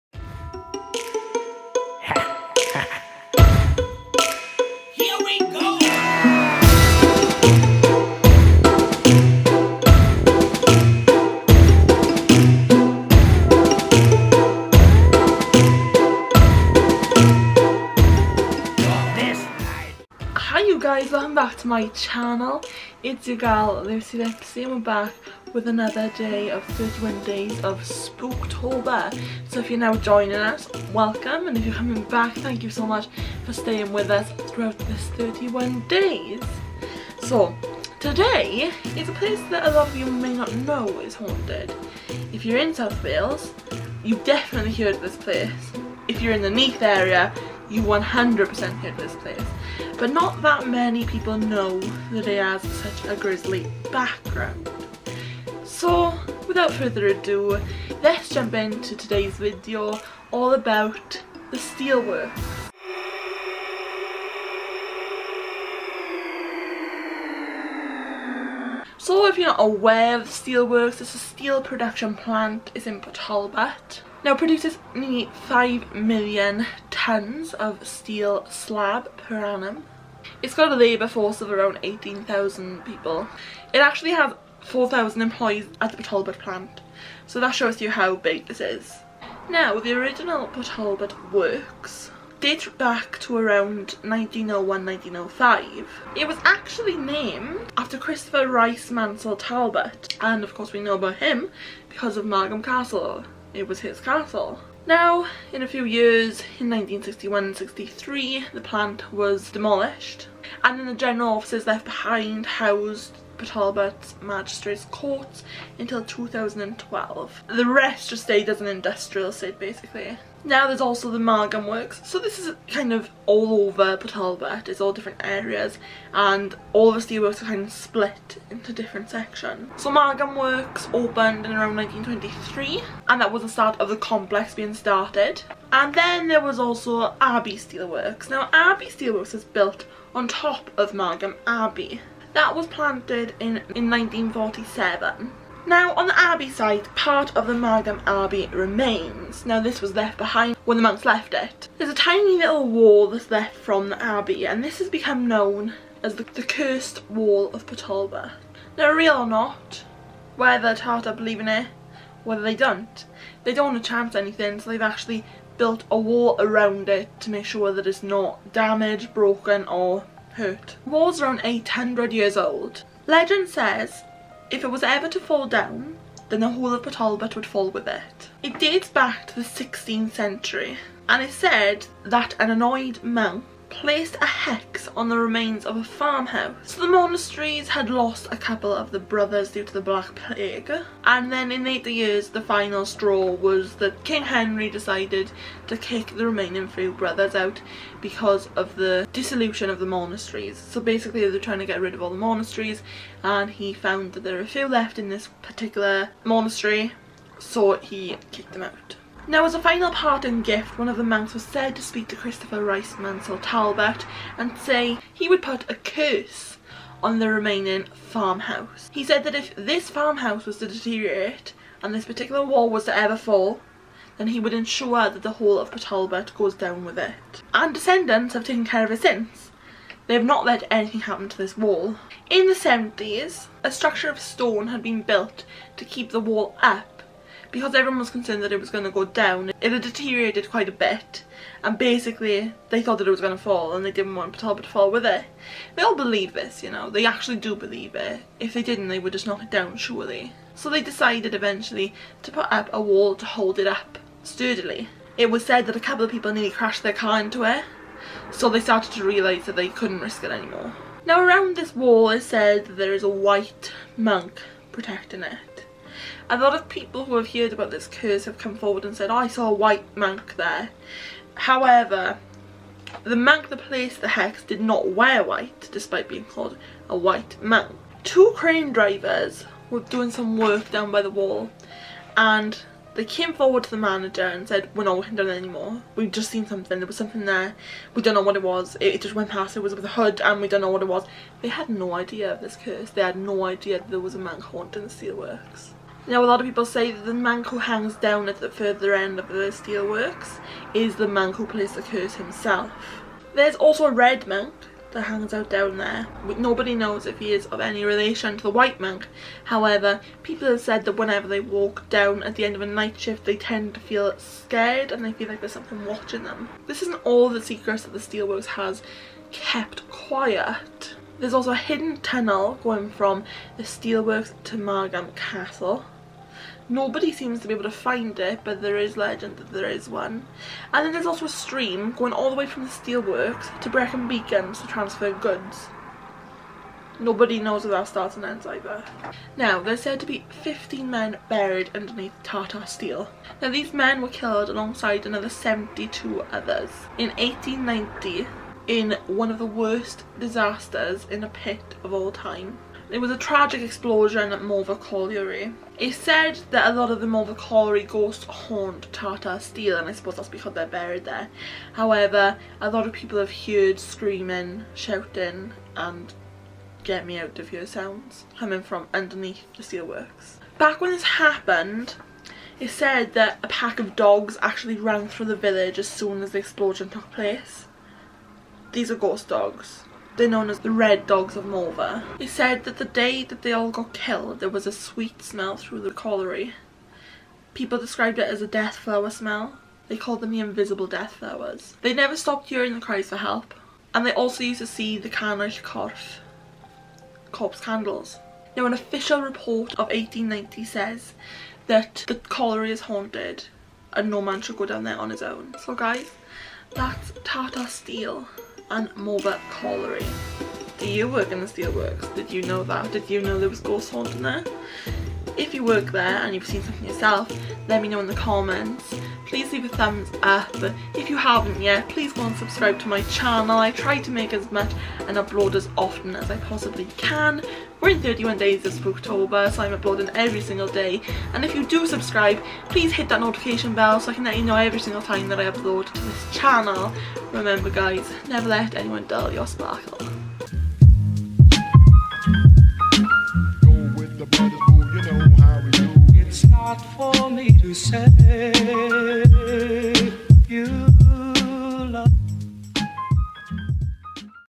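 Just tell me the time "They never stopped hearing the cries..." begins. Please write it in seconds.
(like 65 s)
391 s.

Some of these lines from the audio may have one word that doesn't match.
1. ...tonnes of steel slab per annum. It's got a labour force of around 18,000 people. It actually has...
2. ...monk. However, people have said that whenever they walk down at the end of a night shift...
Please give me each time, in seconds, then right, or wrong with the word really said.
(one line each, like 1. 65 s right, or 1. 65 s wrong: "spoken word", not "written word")
1. 76 s right
2. 308 s right.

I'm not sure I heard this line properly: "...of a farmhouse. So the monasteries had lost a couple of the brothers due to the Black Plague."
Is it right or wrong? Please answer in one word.
right.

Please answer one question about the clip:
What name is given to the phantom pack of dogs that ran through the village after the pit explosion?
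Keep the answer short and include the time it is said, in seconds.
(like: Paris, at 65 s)
Red Dogs of Morfa, at 380 s.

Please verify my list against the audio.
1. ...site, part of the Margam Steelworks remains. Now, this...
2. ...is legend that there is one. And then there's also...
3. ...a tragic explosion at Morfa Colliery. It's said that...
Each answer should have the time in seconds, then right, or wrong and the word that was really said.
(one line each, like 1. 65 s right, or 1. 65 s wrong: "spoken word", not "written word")
1. 146 s wrong: "Abbey", not "Steelworks"
2. 328 s right
3. 353 s right.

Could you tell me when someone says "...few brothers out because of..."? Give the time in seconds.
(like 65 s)
196 s.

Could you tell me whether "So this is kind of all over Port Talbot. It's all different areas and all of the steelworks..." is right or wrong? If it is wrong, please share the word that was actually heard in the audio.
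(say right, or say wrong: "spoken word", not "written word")
right.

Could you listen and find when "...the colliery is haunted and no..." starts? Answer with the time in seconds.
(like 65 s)
402 s.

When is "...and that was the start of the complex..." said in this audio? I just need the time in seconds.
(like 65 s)
133 s.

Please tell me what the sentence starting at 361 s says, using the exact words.
However, a lot of people have heard screaming, shouting and get me out of here sounds coming from underneath the steelworks.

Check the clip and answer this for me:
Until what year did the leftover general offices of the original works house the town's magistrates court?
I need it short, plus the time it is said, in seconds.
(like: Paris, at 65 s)
2012, at 116 s.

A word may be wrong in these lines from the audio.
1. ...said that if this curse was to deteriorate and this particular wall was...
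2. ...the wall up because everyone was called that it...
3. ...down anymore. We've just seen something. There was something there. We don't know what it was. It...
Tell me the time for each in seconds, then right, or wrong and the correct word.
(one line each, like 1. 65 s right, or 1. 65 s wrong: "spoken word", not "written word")
1. 219 s wrong: "farmhouse", not "curse"
2. 236 s wrong: "concerned", not "called"
3. 285 s right.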